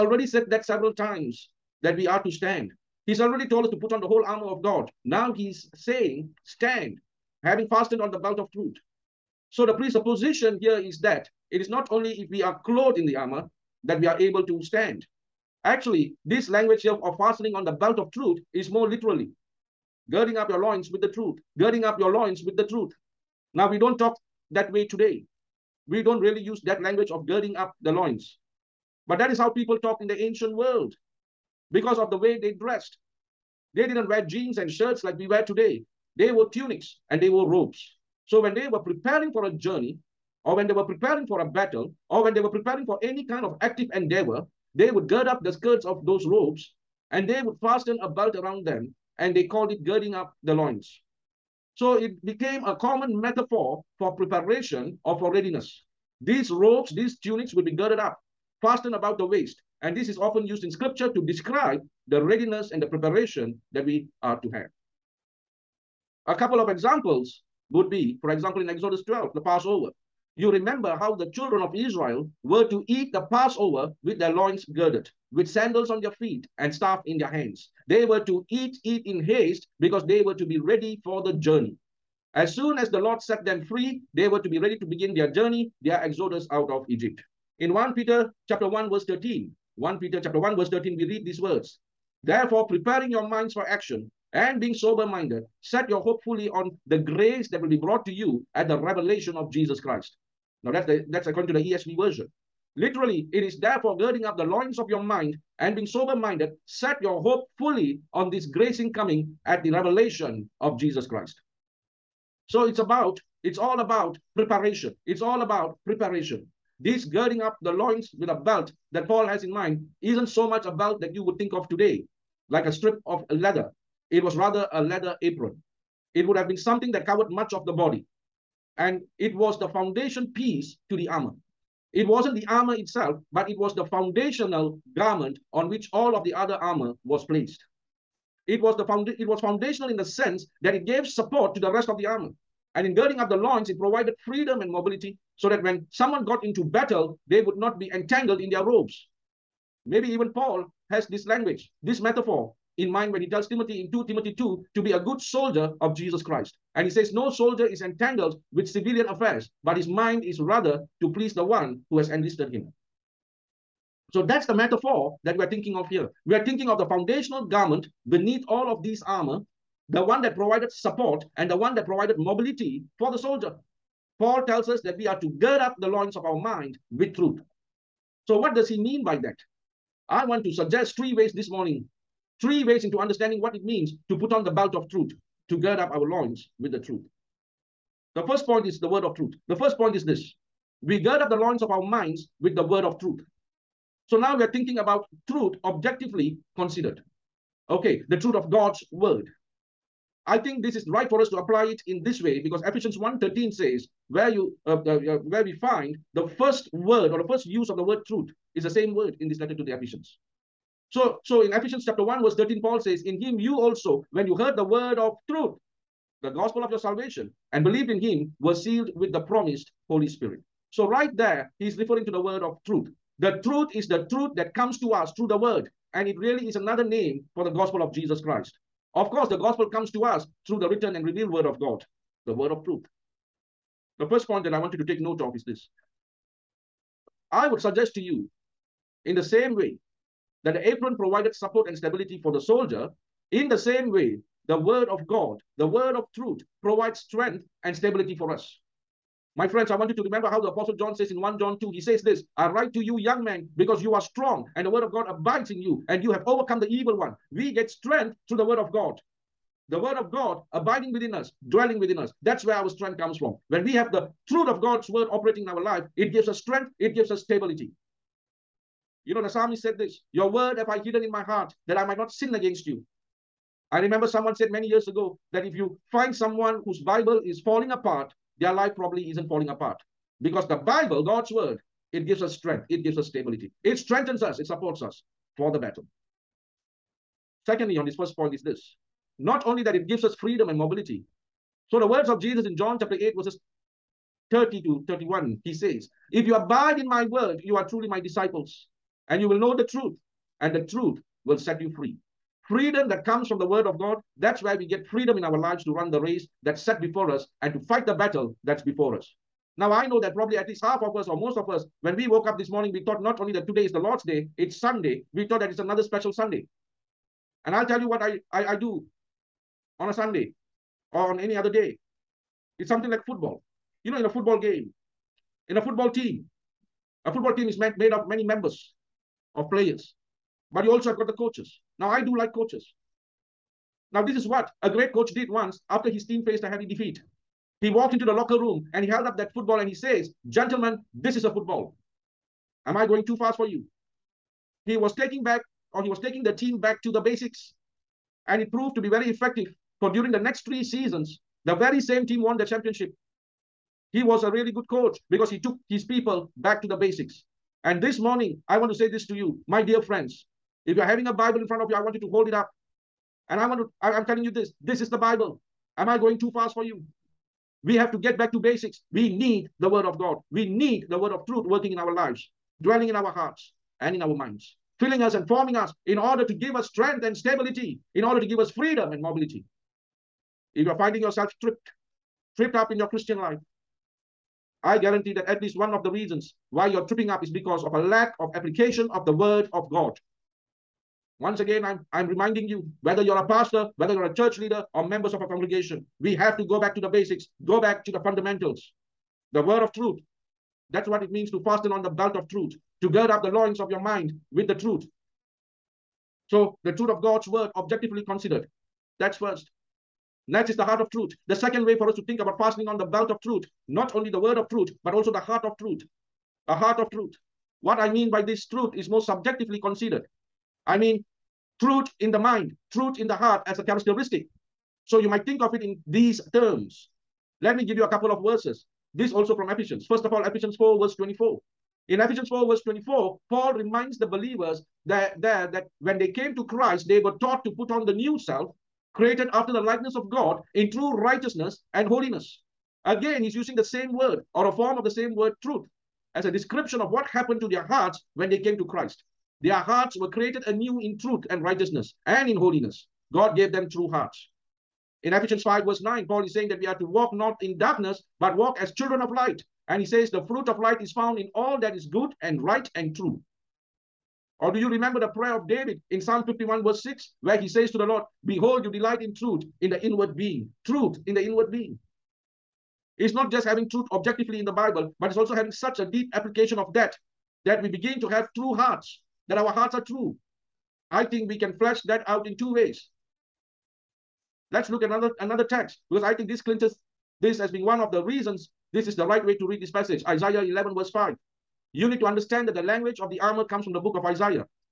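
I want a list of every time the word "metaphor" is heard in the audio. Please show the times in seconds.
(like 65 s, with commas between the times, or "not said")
53 s, 151 s, 164 s.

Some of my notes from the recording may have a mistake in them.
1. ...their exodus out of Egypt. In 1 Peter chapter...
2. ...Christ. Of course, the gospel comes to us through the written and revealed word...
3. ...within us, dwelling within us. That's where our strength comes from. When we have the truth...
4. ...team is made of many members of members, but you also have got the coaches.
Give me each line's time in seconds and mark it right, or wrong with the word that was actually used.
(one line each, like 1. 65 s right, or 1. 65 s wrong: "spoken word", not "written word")
1. 85 s right
2. 228 s right
3. 260 s right
4. 327 s wrong: "players", not "members".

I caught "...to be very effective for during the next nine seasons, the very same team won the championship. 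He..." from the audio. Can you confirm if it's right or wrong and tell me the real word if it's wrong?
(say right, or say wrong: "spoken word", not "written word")
wrong: "three", not "nine".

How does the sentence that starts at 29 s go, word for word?
But that is how people talked in the ancient world because of the way they dressed.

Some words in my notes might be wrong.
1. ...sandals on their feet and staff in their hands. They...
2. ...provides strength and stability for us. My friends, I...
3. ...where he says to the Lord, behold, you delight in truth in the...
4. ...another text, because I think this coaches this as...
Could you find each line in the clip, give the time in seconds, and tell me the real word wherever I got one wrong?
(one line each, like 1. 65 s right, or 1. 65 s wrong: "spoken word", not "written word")
1. 75 s right
2. 246 s right
3. 467 s right
4. 485 s wrong: "clinches", not "coaches".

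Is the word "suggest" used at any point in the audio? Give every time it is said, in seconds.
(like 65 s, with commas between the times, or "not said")
180 s, 237 s.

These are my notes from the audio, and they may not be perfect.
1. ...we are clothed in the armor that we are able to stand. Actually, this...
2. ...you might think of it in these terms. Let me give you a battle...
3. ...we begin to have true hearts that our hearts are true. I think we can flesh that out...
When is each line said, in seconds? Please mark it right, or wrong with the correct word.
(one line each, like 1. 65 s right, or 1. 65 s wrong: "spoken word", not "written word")
1. 12 s right
2. 424 s wrong: "couple", not "battle"
3. 477 s right.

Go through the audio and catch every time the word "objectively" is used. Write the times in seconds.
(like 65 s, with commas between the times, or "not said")
195 s, 407 s, 473 s.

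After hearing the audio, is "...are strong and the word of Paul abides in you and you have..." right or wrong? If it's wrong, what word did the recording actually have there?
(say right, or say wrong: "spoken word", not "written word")
wrong: "God", not "Paul".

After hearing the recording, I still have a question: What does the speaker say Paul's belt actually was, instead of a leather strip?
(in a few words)
A leather apron.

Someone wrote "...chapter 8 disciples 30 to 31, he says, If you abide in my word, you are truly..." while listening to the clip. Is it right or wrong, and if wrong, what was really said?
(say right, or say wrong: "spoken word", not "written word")
wrong: "verses", not "disciples".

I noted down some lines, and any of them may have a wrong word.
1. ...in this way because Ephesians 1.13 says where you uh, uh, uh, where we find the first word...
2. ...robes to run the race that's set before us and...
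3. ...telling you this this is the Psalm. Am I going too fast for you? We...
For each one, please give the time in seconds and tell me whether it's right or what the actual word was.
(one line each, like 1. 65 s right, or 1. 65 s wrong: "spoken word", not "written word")
1. 201 s right
2. 305 s wrong: "lives", not "robes"
3. 364 s wrong: "Bible", not "Psalm".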